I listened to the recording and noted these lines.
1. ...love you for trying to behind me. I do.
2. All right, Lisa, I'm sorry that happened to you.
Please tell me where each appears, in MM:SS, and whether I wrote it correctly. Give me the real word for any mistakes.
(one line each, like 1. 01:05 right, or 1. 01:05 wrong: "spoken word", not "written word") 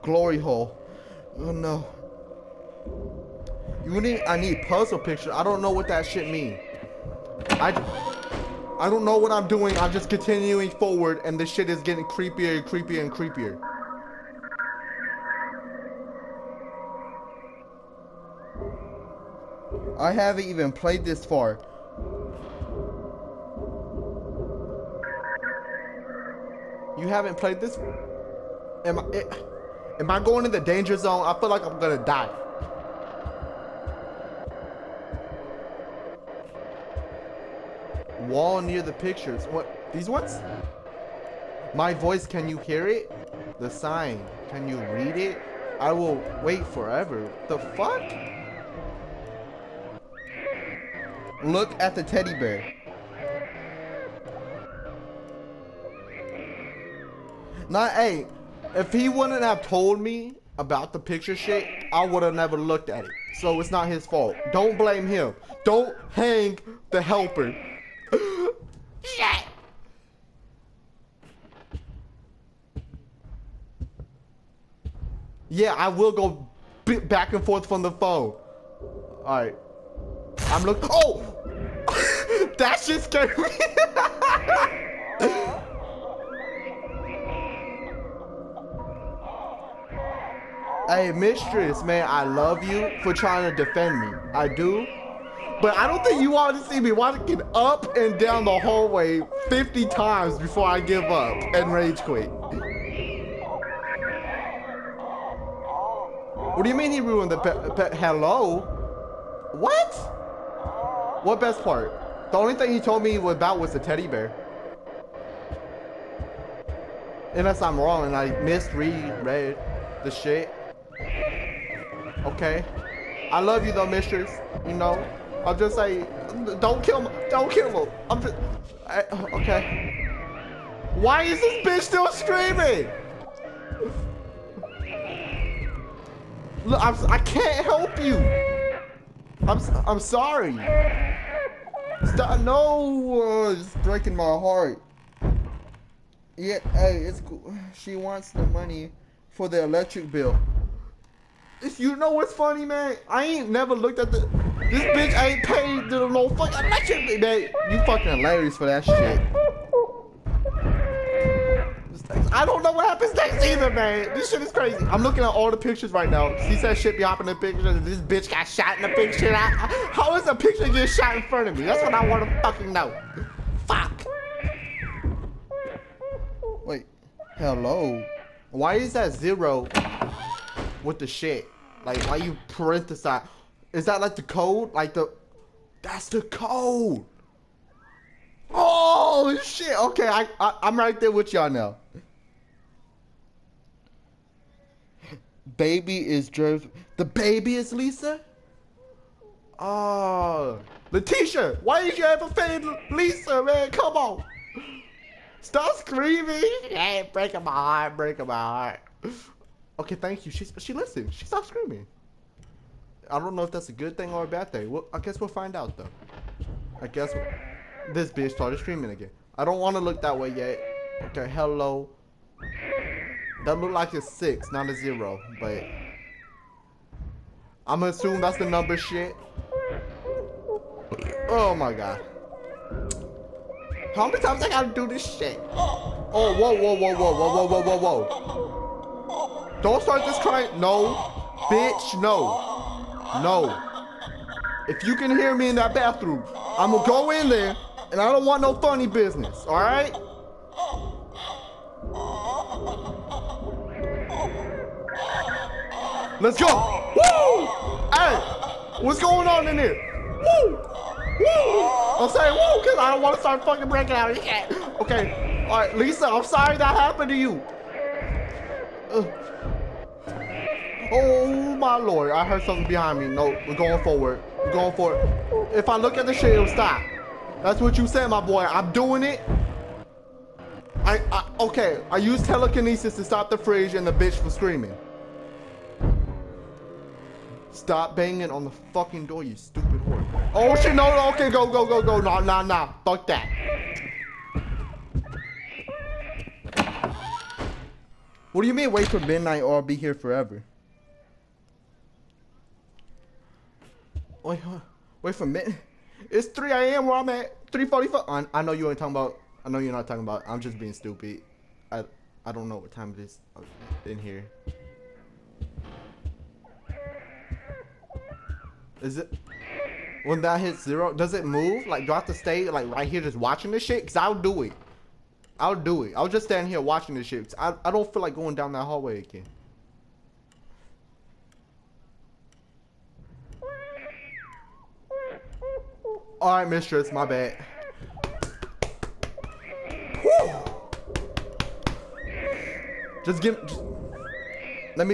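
1. 01:32 wrong: "defend", not "behind"
2. 04:25 right.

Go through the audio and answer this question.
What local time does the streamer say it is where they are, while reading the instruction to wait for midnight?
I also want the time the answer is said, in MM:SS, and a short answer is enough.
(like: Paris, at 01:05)
3:45, at 05:07.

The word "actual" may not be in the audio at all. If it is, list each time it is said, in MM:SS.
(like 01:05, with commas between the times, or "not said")
not said.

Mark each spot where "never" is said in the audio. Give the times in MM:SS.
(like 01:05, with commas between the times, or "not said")
01:02, 02:33.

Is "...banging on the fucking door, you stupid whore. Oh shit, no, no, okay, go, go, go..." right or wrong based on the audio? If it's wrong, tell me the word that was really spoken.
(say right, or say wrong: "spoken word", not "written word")
right.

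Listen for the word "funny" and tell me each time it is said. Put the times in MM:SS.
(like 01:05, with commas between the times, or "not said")
02:32, 04:08.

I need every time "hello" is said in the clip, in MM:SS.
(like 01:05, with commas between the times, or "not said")
01:47, 02:57, 03:41.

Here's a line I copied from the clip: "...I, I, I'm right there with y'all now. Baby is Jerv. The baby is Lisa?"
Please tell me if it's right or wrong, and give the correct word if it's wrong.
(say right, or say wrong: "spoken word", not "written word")
right.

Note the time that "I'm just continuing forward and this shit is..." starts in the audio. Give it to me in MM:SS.
00:09.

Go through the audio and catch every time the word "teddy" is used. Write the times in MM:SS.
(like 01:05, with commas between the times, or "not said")
00:52, 01:53.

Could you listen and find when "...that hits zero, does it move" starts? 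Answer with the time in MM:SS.
05:20.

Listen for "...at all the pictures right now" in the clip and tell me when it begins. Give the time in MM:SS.
02:45.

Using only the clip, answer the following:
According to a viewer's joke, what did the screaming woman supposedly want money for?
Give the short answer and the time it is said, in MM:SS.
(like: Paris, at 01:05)
electric bill, at 02:29.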